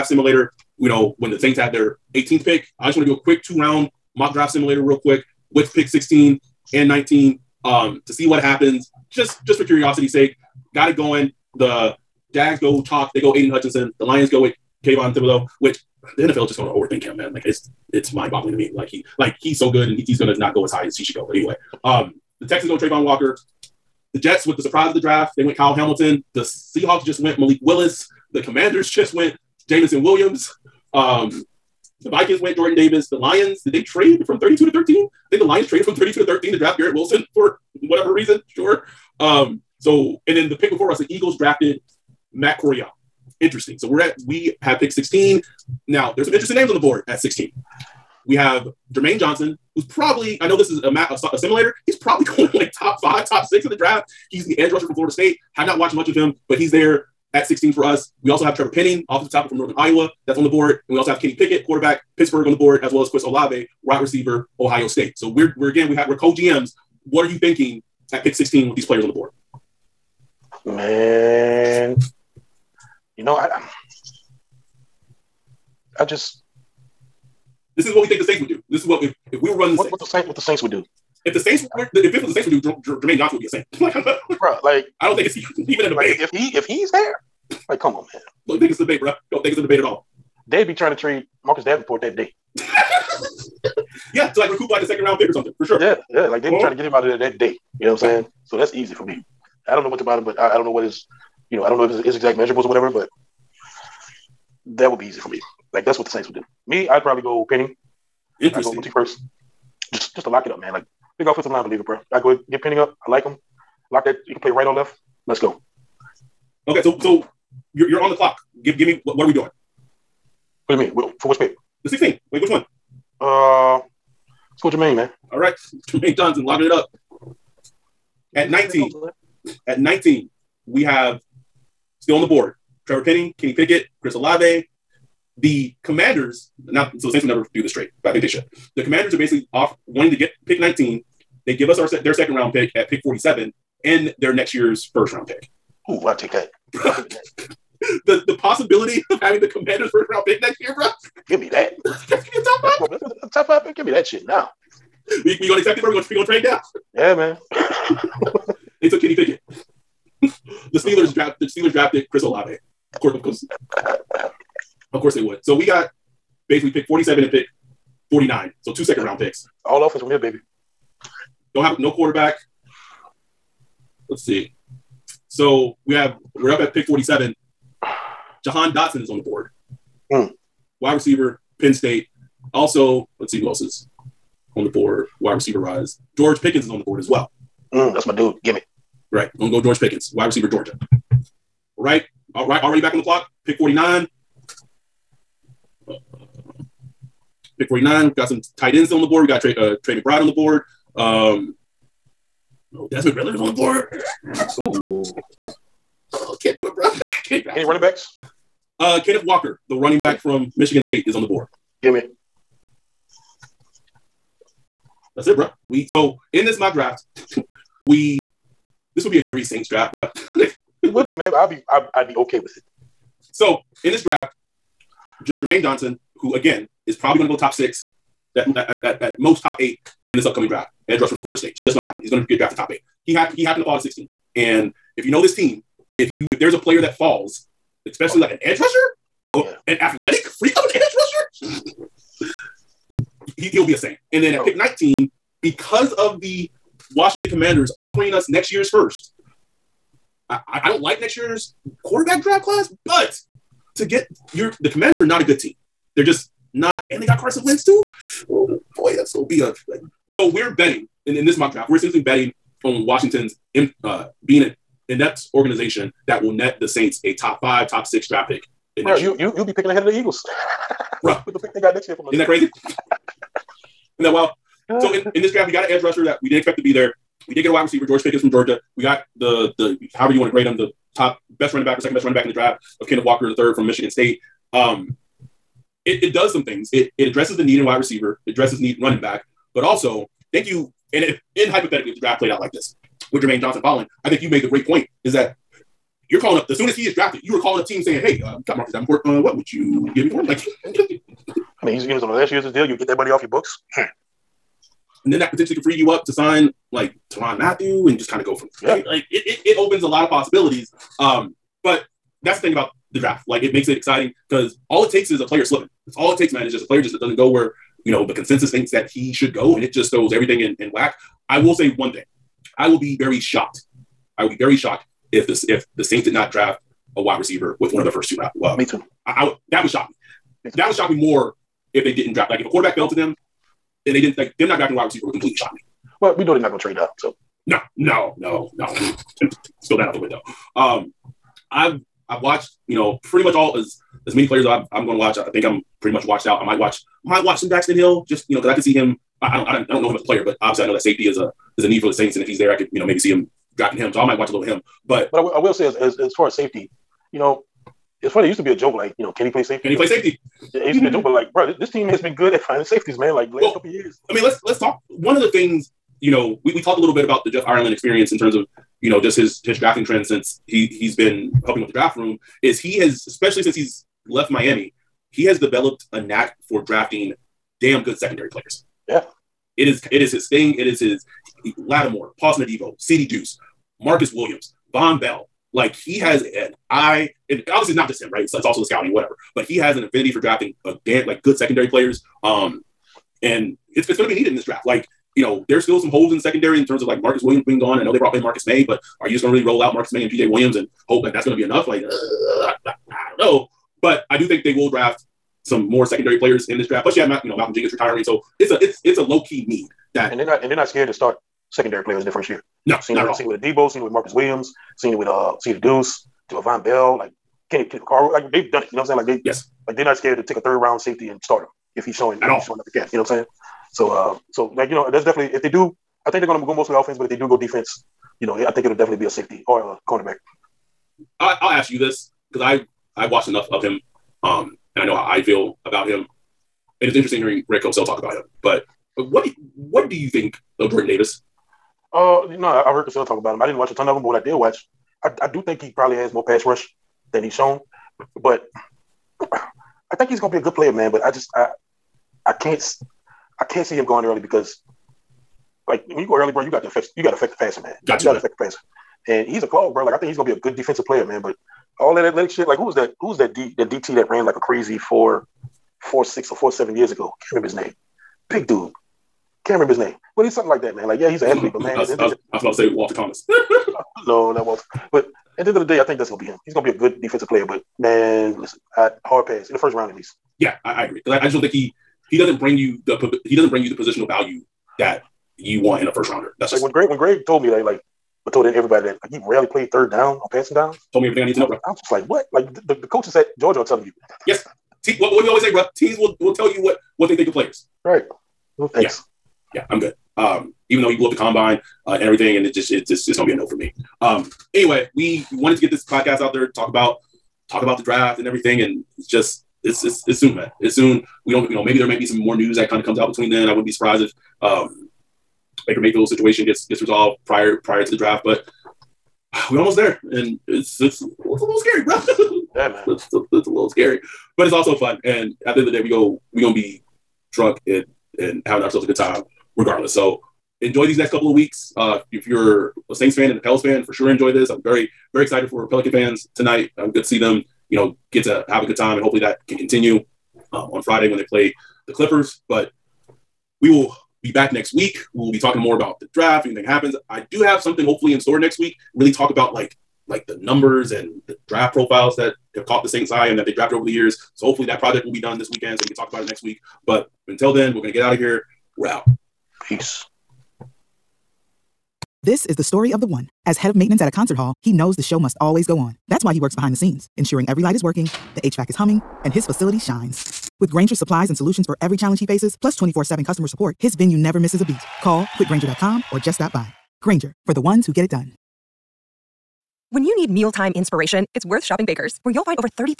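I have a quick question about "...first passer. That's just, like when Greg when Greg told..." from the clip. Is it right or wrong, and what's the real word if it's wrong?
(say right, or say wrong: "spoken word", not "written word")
wrong: "rounder", not "passer".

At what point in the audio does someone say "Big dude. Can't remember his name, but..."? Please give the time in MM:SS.
07:48.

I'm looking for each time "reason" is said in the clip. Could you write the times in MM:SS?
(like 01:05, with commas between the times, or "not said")
00:38.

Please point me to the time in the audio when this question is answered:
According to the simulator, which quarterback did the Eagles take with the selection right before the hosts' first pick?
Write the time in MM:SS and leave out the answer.
00:42.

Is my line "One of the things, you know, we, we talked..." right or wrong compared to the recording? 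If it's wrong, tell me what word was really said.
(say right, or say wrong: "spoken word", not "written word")
right.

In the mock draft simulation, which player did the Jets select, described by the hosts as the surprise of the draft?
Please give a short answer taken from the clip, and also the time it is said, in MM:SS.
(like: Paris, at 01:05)
Kyle Hamilton, at 00:25.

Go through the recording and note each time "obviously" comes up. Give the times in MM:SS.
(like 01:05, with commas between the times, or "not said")
05:50, 06:27.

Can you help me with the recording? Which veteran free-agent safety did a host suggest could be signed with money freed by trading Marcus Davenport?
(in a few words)
Tyrann Mathieu.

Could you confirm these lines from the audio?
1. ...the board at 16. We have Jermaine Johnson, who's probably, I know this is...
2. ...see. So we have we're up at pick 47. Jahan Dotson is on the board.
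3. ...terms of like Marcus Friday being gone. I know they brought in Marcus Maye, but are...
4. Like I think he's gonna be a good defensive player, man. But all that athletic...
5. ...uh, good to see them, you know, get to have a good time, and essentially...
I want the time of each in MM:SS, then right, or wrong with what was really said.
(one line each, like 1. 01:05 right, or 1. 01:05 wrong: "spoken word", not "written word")
1. 00:46 right
2. 02:54 right
3. 06:36 wrong: "Williams", not "Friday"
4. 07:39 right
5. 08:56 wrong: "hopefully", not "essentially".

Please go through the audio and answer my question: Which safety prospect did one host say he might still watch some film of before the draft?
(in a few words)
Daxton Hill.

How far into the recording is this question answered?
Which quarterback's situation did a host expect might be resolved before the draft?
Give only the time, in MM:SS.
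08:35.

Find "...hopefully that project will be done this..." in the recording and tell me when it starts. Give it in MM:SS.
09:14.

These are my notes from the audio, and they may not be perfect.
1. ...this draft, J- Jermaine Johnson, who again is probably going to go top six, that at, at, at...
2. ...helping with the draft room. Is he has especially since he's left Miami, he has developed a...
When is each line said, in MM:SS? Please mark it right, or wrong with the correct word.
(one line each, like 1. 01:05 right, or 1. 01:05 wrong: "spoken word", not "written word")
1. 03:43 right
2. 06:11 right.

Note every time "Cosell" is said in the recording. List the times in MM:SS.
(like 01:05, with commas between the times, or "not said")
07:17, 07:22.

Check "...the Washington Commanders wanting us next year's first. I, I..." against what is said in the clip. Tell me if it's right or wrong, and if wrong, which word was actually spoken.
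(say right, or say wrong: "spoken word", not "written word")
wrong: "offering", not "wanting".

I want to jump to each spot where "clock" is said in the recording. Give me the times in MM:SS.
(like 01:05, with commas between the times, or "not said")
01:58, 03:13.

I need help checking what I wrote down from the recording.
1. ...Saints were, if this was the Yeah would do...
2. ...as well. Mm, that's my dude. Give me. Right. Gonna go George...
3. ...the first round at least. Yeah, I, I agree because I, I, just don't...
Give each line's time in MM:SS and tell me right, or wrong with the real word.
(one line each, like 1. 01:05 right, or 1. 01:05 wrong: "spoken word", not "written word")
1. 01:21 wrong: "Saints", not "Yeah"
2. 03:06 right
3. 07:59 right.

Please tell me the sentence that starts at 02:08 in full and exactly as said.
At 19, at 19, we have still on the board Trevor Penning, Kenny Pickett, Chris Olave.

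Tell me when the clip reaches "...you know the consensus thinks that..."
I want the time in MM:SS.
05:17.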